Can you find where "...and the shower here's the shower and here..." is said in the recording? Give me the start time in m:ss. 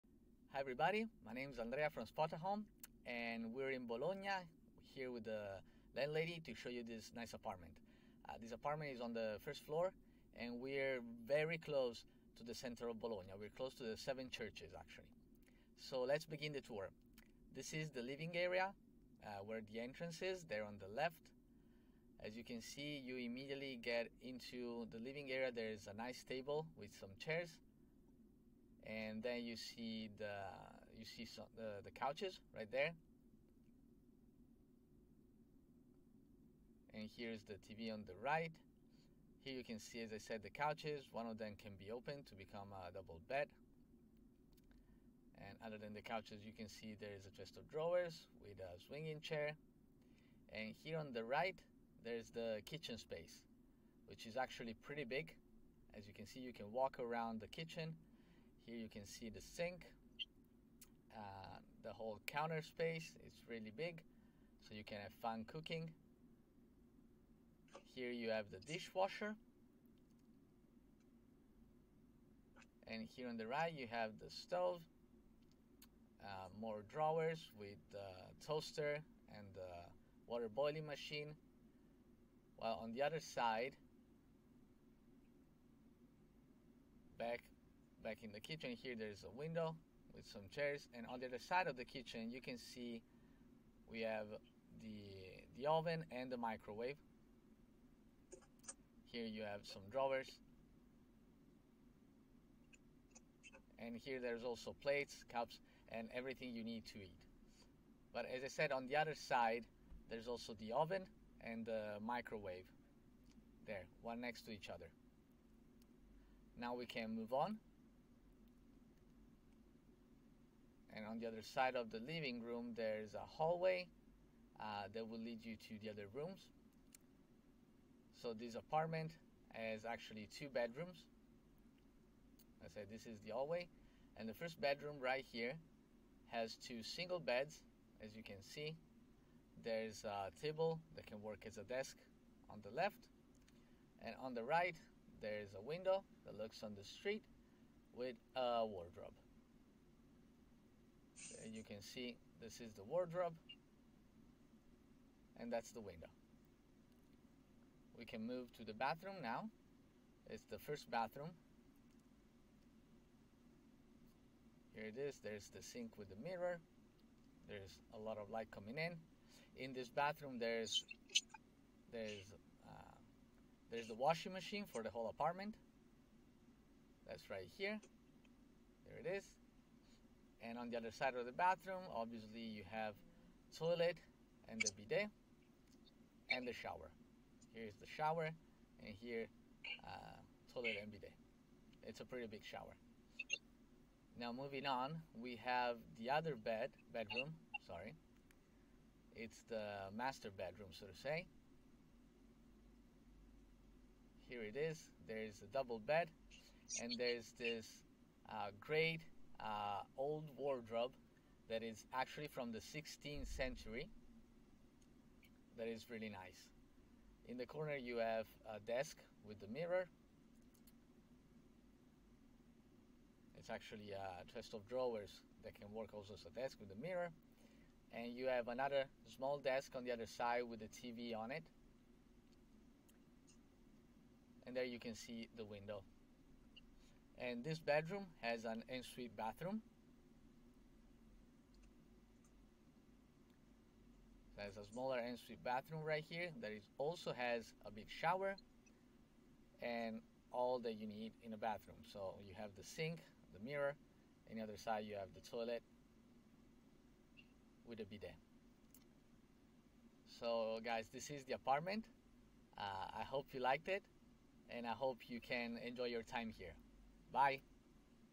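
3:06.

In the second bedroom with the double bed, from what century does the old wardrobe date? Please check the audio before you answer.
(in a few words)
16th century.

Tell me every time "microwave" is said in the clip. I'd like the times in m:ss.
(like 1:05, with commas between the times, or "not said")
1:36, 1:52.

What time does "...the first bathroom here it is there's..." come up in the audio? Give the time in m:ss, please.
2:40.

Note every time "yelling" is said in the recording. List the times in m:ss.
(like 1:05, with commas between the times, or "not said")
not said.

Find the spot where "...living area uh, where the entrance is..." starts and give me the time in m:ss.
0:18.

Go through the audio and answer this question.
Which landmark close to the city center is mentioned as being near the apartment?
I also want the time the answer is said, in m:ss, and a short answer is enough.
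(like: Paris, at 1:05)
the seven churches, at 0:13.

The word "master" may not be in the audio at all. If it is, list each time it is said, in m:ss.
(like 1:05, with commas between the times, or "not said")
3:19.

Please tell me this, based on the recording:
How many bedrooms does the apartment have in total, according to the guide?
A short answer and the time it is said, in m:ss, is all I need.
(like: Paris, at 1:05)
2, at 2:10.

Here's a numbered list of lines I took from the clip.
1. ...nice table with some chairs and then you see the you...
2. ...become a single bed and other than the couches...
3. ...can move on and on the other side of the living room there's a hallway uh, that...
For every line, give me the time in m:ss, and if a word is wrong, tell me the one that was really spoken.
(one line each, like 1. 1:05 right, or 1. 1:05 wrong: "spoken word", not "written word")
1. 0:25 right
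2. 0:42 wrong: "double", not "single"
3. 1:56 right.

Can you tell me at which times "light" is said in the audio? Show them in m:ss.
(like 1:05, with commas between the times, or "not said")
2:48.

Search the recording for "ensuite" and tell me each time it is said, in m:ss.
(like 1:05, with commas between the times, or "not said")
3:58, 4:04.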